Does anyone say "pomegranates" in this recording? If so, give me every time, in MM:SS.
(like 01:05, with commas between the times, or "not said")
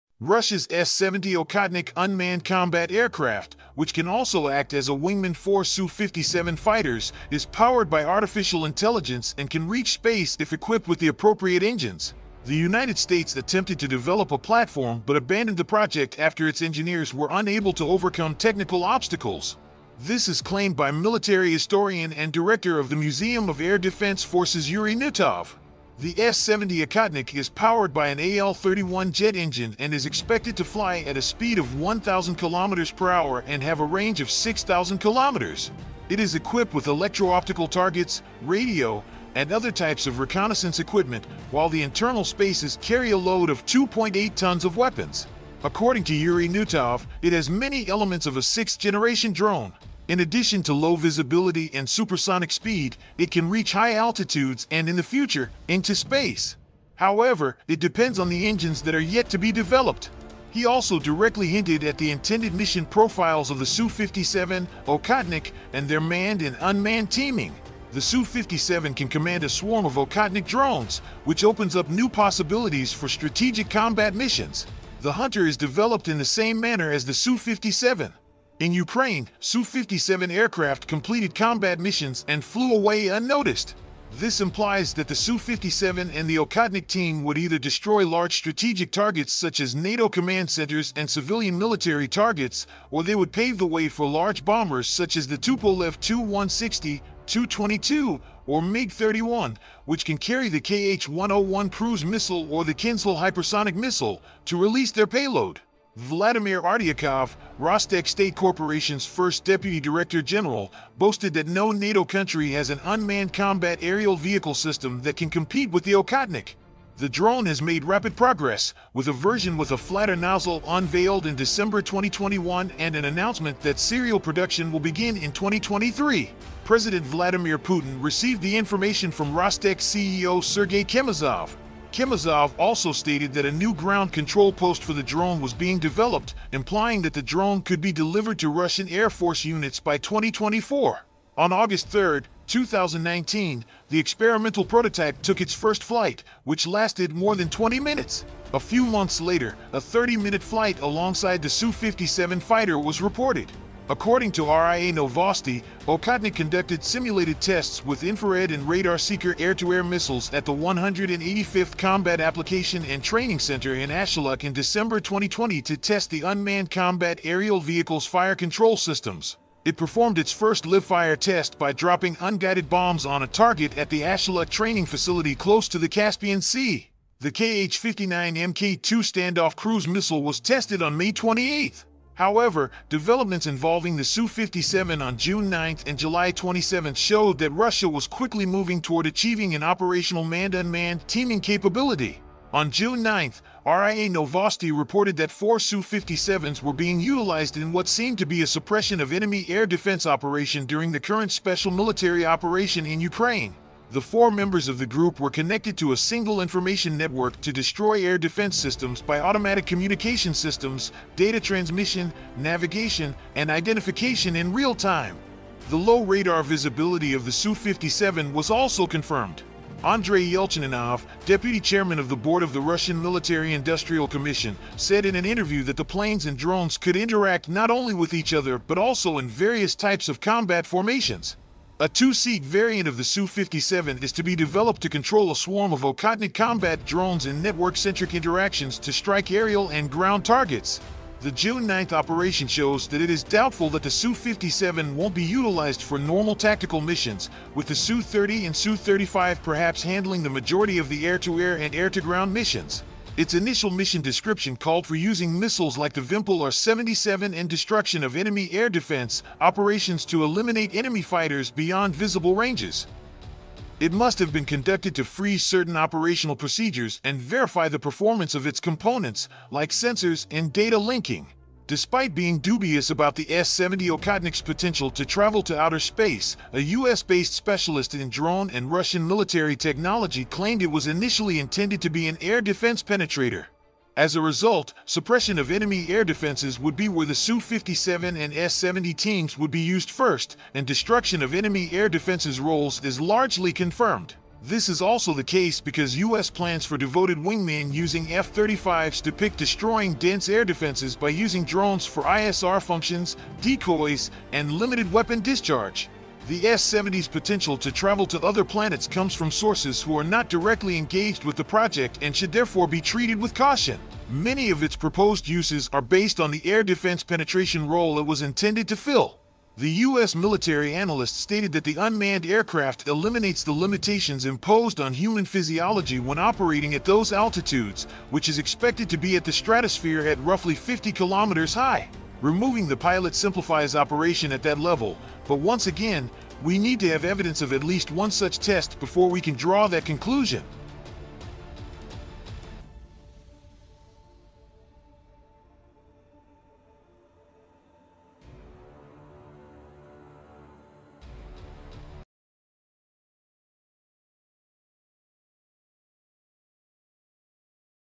not said.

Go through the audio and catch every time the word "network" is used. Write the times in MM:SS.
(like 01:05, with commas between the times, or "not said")
03:26, 03:57.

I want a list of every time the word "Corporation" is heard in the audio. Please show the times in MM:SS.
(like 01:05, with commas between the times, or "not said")
01:48.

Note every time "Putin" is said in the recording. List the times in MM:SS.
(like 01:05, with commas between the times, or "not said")
02:07.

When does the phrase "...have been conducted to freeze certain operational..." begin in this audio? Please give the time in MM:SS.
04:24.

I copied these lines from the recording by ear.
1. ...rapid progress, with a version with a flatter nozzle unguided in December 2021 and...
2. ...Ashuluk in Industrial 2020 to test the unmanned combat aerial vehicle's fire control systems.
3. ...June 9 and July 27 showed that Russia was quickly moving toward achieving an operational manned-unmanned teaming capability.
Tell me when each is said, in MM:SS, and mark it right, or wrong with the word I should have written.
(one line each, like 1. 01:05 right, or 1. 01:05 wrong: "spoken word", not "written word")
1. 01:57 wrong: "unveiled", not "unguided"
2. 02:43 wrong: "December", not "Industrial"
3. 03:05 right.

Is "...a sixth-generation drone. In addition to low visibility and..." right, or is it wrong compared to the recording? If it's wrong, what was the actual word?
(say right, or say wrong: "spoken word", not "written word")
right.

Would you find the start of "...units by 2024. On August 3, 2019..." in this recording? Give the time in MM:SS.
02:19.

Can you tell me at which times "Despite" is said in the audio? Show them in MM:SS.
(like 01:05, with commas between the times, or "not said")
04:31.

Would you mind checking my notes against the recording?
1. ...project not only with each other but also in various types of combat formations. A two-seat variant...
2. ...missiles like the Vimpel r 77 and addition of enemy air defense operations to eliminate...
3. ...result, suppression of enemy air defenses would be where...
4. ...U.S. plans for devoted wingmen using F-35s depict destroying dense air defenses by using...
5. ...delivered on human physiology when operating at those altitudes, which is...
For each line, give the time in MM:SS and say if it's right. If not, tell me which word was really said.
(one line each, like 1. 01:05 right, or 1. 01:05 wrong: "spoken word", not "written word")
1. 03:46 wrong: "interact", not "project"
2. 04:15 wrong: "destruction", not "addition"
3. 04:44 right
4. 04:55 right
5. 05:24 wrong: "imposed", not "delivered".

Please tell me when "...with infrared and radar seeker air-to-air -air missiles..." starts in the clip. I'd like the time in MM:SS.
02:37.